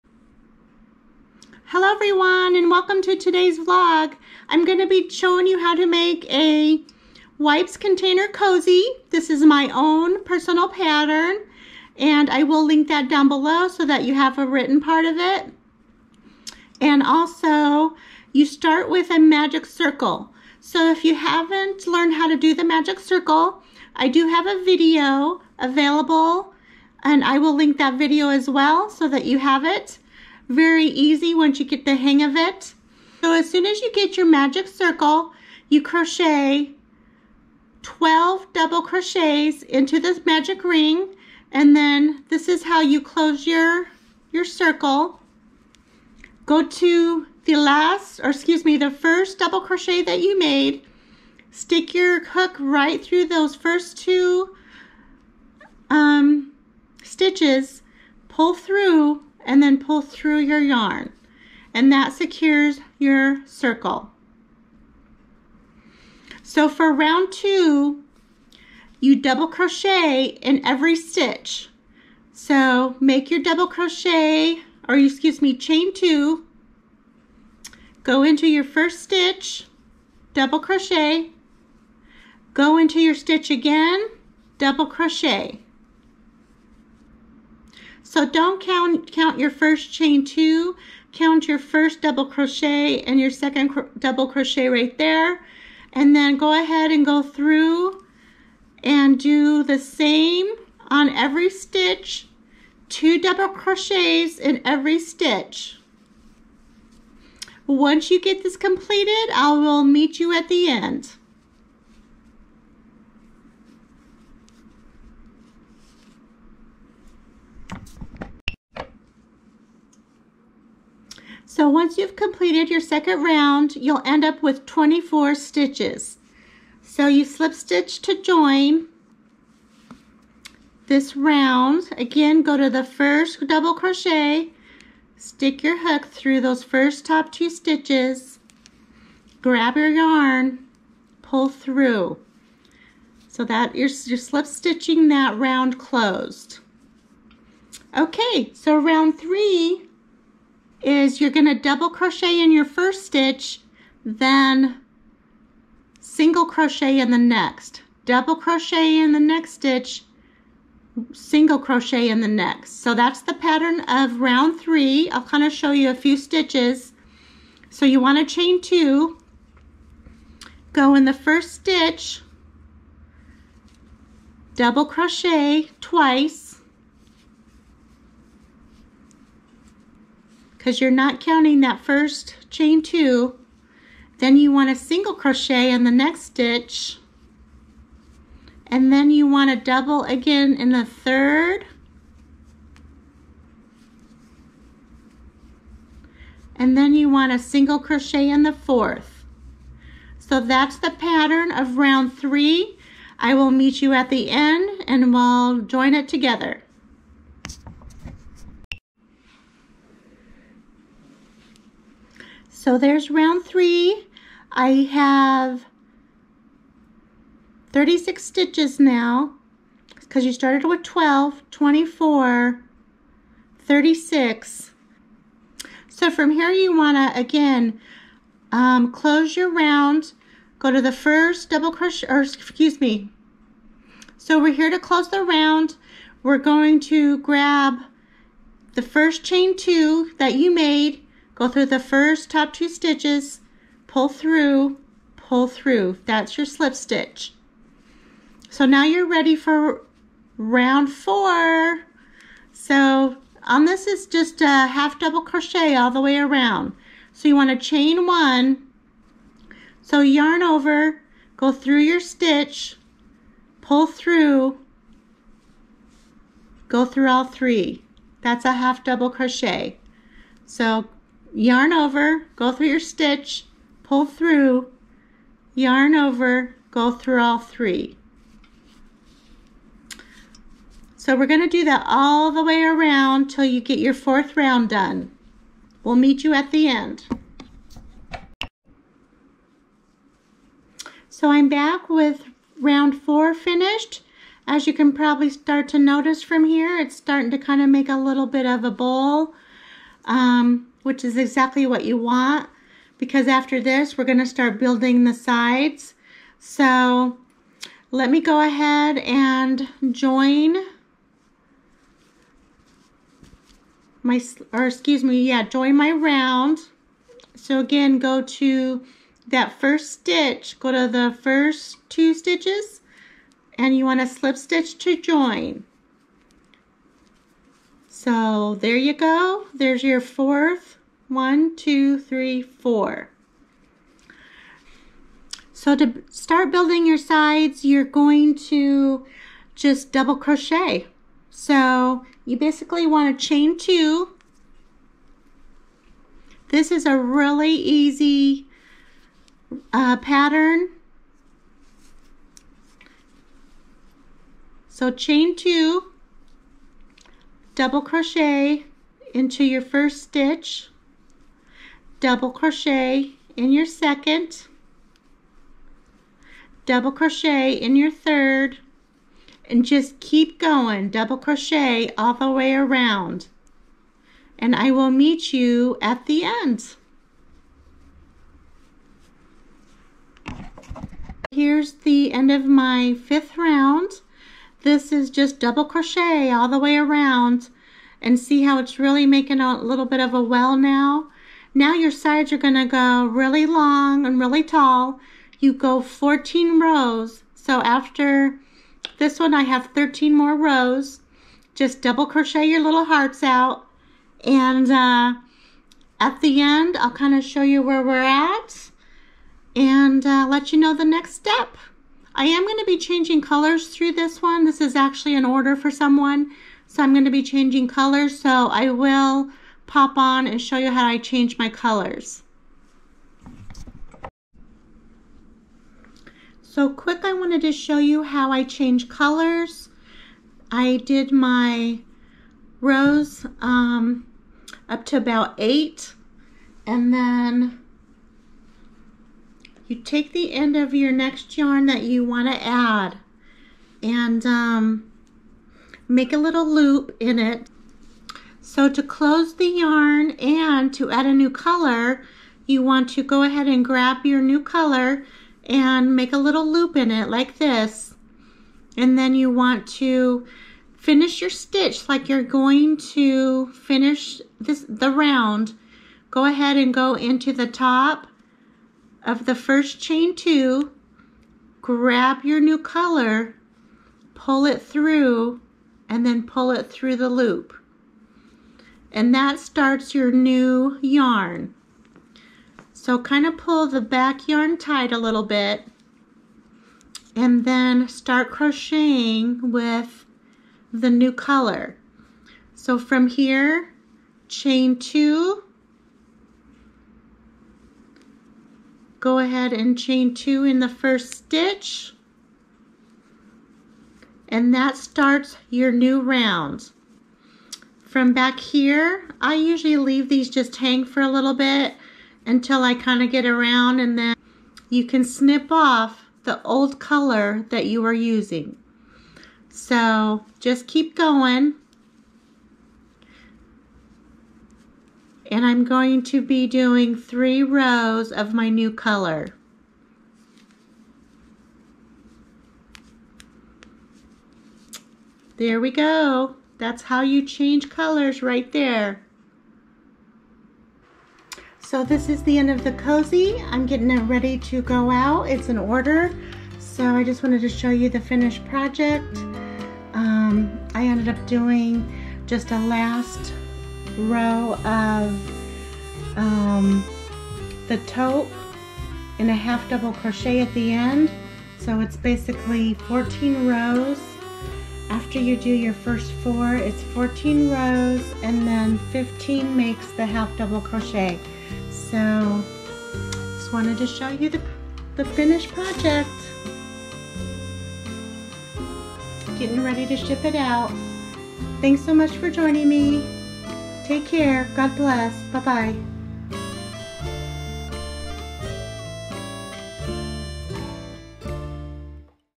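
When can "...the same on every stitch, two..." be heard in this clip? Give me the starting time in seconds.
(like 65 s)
99 s.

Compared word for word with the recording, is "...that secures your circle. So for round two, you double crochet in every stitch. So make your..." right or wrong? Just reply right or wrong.
right.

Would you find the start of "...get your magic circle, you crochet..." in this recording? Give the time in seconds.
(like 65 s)
33 s.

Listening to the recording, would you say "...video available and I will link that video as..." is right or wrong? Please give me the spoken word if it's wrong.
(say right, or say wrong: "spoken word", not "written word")
right.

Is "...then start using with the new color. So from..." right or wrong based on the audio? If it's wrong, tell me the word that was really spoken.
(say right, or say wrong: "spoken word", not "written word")
wrong: "crocheting", not "using".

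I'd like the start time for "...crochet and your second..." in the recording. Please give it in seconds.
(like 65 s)
92 s.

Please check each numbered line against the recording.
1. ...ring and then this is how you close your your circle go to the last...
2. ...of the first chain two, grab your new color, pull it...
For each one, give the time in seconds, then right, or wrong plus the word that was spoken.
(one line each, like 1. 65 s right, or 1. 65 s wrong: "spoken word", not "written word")
1. 40 s right
2. 469 s right.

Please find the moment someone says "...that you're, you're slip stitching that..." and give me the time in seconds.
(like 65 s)
143 s.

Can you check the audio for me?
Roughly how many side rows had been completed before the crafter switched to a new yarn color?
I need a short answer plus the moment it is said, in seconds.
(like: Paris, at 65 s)
8, at 435 s.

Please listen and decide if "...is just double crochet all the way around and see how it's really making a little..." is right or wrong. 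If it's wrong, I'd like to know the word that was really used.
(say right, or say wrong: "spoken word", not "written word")
right.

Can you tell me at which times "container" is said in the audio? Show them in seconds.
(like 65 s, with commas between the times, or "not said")
7 s.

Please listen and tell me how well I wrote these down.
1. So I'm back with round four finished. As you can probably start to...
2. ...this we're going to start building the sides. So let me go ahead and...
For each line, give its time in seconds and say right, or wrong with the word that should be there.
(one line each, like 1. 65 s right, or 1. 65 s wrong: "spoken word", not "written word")
1. 291 s right
2. 303 s right.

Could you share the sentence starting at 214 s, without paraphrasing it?
I have 36 stitches now because you started with 12, 24, 36.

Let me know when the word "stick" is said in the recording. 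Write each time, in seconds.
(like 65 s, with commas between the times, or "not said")
51 s, 135 s.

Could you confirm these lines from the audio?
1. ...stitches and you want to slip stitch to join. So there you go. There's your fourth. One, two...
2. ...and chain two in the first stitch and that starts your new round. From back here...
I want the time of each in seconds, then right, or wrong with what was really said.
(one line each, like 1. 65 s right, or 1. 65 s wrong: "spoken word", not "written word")
1. 322 s right
2. 499 s right.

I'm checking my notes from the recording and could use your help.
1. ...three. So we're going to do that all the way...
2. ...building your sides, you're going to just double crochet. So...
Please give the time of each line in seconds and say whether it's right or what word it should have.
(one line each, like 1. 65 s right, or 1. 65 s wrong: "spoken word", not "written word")
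1. 277 s right
2. 336 s right.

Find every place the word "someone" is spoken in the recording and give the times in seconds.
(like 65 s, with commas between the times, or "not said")
415 s.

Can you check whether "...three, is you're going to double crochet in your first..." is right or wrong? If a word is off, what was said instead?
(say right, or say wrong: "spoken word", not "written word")
right.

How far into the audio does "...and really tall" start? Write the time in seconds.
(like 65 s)
394 s.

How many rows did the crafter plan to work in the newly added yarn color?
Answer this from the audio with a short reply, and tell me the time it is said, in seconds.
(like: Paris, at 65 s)
3, at 526 s.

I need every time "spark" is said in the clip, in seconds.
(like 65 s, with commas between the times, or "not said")
not said.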